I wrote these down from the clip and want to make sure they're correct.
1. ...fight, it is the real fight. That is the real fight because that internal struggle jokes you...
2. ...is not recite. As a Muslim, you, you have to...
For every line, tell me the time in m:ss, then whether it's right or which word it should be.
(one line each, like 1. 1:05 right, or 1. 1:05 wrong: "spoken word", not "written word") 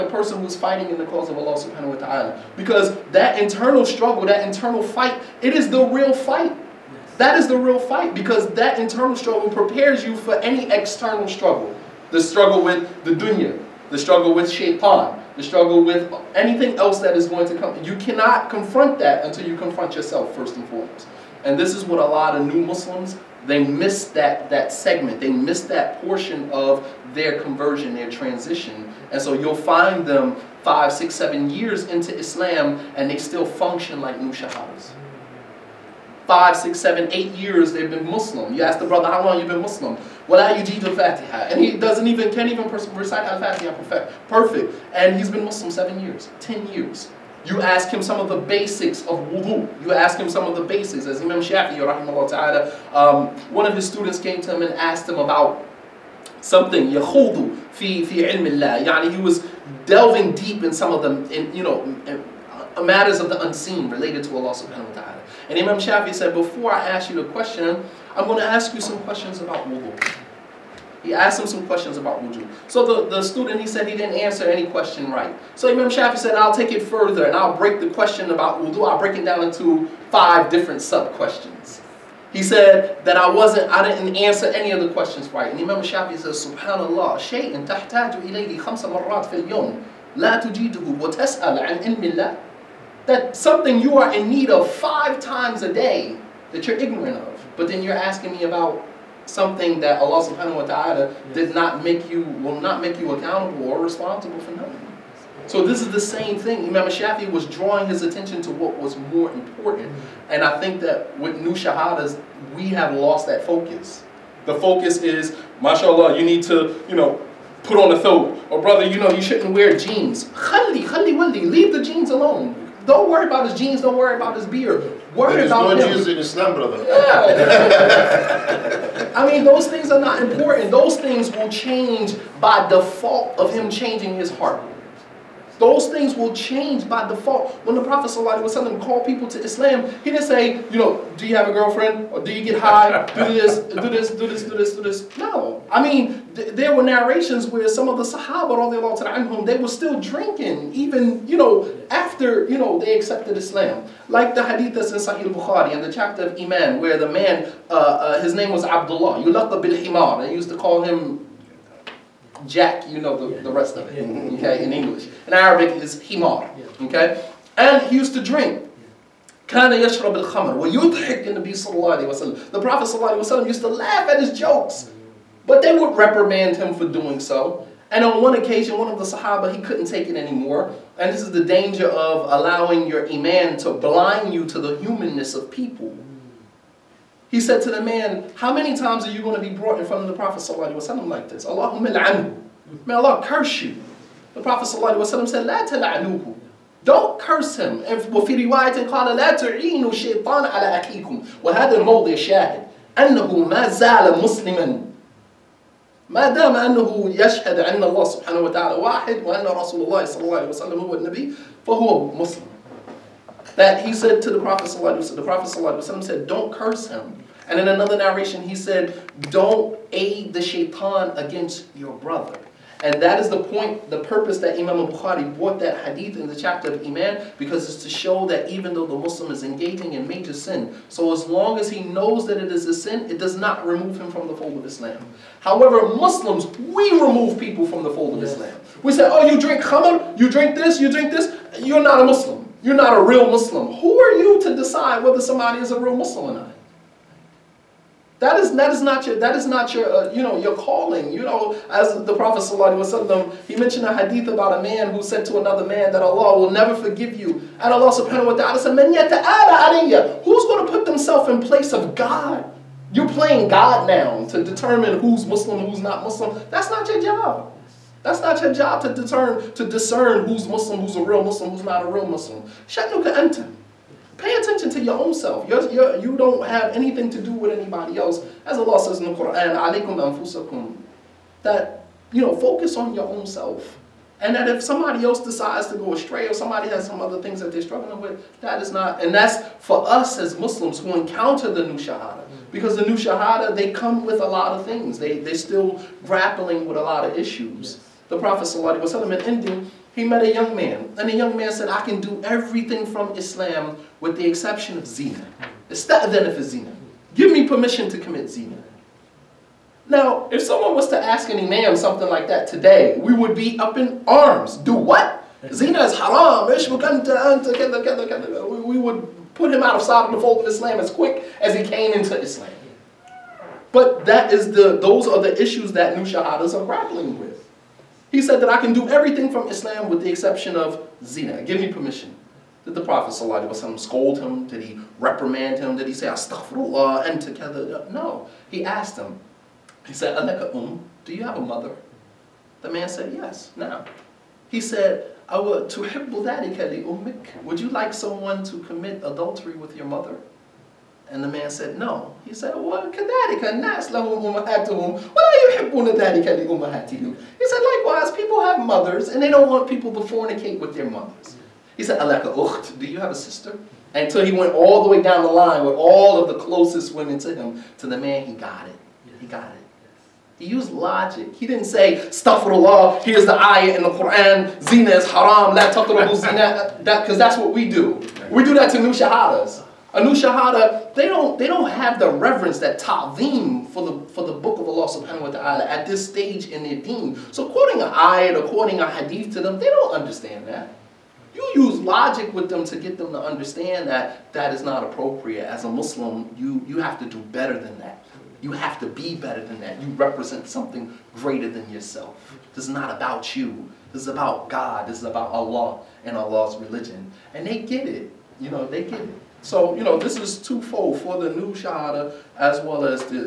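1. 0:04 wrong: "prepares", not "jokes"
2. 6:34 wrong: "appropriate", not "recite".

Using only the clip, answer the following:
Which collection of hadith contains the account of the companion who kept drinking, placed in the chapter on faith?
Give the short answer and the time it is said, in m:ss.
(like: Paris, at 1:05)
Sahih Bukhari, at 2:35.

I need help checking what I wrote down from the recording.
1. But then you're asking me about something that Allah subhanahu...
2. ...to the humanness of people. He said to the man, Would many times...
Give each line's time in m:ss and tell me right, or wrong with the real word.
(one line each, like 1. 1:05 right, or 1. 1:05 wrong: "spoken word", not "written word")
1. 1:37 right
2. 3:04 wrong: "How", not "Would".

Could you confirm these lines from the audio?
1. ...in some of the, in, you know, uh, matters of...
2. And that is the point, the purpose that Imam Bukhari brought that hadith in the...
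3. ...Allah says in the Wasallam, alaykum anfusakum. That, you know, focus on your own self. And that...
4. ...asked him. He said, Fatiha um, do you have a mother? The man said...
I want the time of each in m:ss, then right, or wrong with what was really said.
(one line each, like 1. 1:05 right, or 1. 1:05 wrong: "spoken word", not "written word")
1. 1:00 right
2. 3:42 right
3. 4:38 wrong: "Quran", not "Wasallam"
4. 5:38 wrong: "Aleka", not "Fatiha".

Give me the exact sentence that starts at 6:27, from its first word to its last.
So quoting an ayat or quoting a hadith to them, they don't understand that.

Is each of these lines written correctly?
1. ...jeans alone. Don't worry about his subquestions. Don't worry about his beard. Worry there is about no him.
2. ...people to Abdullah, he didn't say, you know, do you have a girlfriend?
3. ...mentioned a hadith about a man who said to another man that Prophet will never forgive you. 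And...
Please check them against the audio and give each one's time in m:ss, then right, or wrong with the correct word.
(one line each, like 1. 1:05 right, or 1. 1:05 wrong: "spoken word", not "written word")
1. 2:01 wrong: "jeans", not "subquestions"
2. 2:19 wrong: "Islam", not "Abdullah"
3. 4:13 wrong: "Allah", not "Prophet".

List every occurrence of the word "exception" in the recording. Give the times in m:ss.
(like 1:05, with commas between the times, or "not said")
5:04, 5:30.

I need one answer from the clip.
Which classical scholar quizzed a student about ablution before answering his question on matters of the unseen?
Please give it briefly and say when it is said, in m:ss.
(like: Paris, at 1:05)
Imam Shafi'i, at 0:51.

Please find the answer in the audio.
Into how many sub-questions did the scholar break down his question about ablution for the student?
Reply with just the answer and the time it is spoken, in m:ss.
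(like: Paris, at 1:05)
5, at 1:20.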